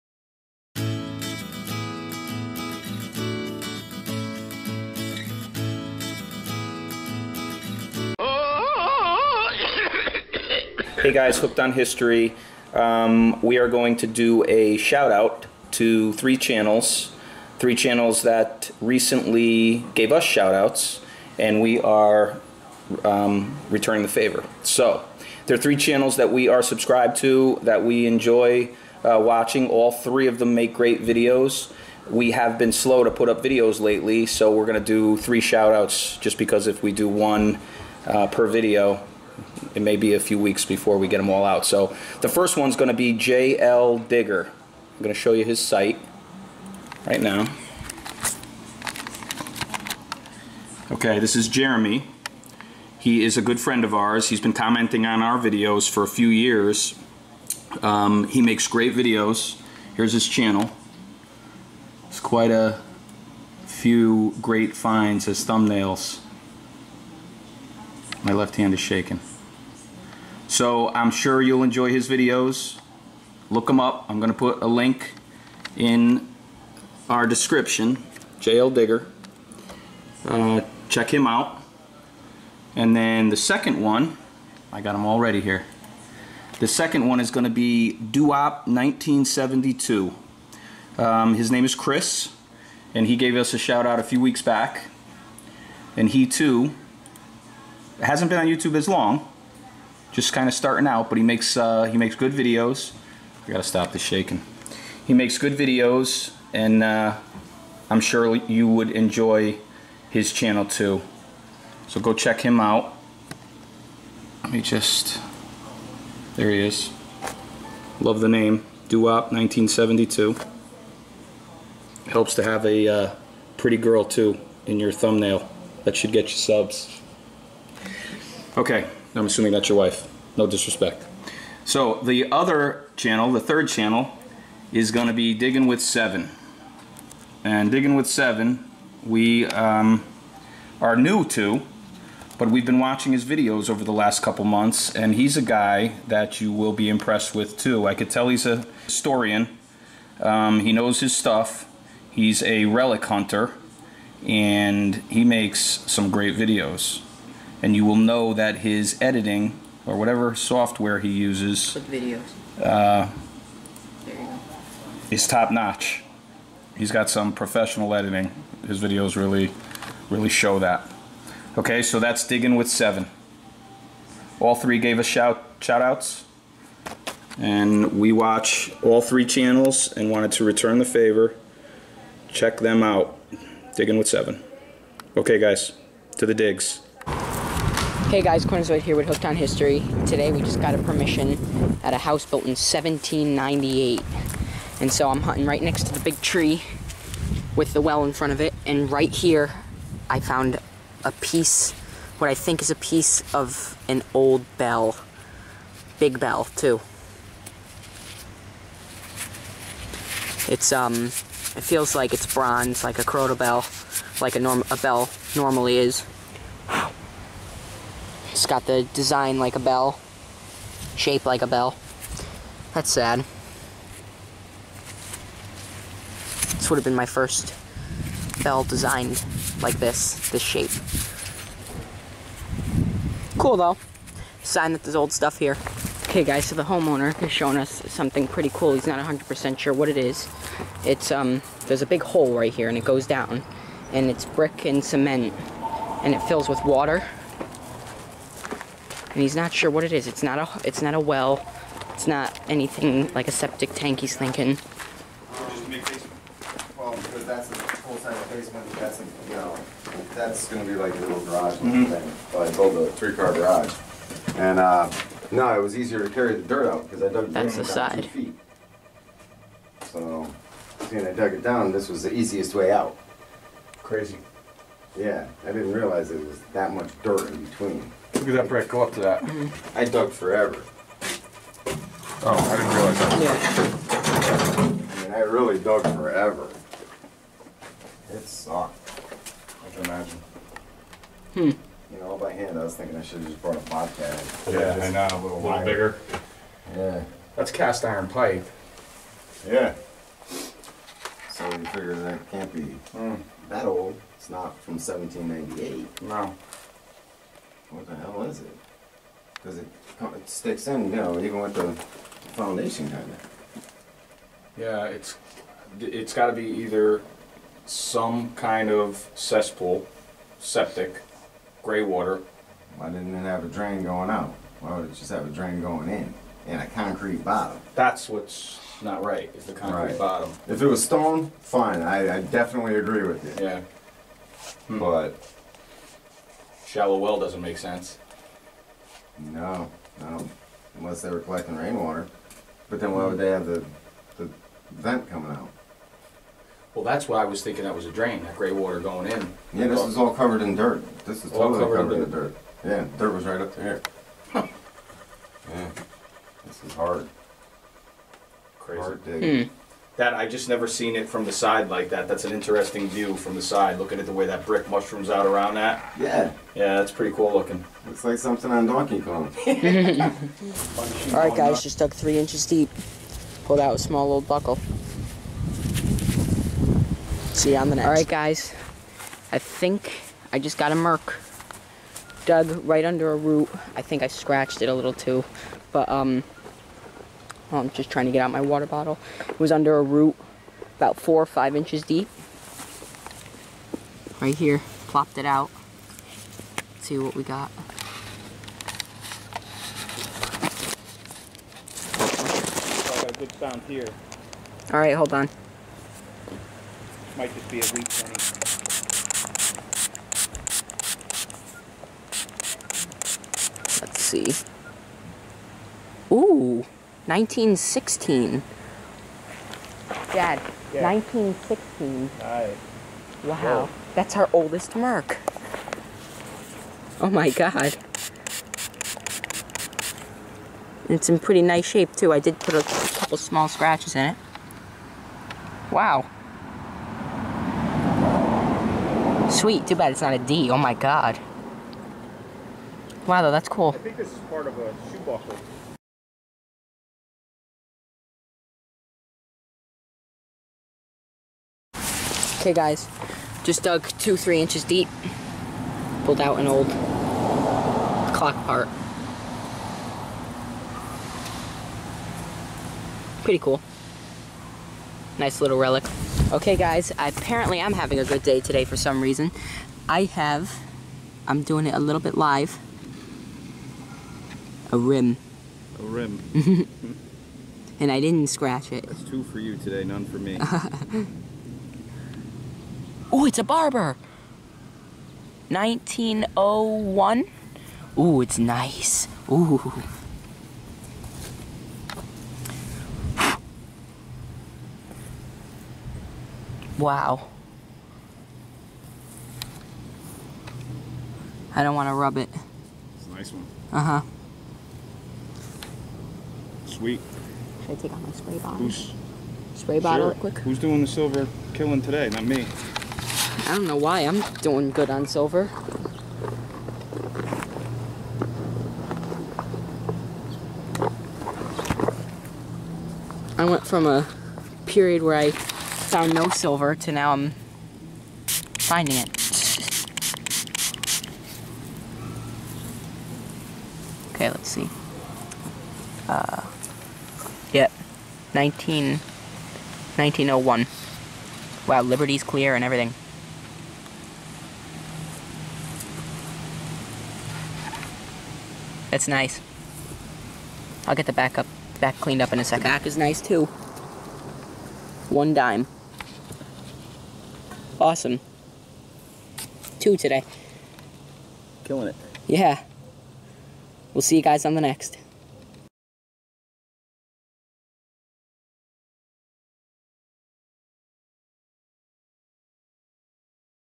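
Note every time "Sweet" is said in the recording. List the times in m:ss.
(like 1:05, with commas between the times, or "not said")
7:19, 8:26.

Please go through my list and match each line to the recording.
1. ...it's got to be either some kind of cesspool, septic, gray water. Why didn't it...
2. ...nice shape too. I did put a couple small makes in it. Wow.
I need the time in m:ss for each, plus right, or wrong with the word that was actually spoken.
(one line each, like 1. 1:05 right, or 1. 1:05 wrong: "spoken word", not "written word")
1. 5:15 right
2. 7:11 wrong: "scratches", not "makes".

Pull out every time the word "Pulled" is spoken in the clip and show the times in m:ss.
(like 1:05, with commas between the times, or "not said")
6:13, 7:36.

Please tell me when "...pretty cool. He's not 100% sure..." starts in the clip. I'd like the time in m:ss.
3:58.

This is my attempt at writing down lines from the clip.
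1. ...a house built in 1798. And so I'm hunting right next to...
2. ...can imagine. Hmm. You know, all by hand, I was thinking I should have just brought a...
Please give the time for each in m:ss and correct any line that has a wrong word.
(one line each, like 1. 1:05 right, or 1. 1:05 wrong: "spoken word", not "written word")
1. 3:11 right
2. 4:49 right.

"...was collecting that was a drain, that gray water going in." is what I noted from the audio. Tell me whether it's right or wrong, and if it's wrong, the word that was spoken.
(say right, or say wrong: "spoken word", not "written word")
wrong: "thinking", not "collecting".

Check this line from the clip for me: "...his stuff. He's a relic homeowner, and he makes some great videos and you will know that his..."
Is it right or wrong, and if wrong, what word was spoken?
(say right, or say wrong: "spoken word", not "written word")
wrong: "hunter", not "homeowner".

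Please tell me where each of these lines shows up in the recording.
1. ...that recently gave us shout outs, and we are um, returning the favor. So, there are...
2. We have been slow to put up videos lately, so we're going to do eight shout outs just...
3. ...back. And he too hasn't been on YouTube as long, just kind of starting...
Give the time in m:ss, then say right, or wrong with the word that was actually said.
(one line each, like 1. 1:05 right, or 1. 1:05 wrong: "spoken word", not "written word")
1. 0:18 right
2. 0:32 wrong: "three", not "eight"
3. 1:34 right.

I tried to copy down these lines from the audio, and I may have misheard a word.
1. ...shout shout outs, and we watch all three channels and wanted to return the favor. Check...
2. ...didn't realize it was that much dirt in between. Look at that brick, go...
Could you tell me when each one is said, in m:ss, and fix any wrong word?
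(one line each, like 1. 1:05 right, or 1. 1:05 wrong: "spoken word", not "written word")
1. 2:55 right
2. 4:35 right.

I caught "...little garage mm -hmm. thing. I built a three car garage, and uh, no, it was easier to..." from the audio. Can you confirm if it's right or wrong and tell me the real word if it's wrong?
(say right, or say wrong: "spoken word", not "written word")
right.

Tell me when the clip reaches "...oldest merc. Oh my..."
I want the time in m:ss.
7:04.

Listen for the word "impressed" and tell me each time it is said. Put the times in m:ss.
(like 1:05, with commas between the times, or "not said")
2:26.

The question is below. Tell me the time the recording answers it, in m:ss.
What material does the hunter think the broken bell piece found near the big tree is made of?
3:32.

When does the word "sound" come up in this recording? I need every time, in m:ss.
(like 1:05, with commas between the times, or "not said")
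6:43.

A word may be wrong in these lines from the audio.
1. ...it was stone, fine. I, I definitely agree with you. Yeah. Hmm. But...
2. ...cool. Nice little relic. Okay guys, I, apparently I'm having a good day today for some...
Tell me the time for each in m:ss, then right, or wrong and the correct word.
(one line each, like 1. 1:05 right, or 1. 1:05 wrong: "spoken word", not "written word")
1. 5:30 right
2. 7:43 right.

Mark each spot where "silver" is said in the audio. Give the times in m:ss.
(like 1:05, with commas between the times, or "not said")
8:30, 8:35, 8:46.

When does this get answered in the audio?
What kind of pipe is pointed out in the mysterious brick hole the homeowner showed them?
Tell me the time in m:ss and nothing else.
4:57.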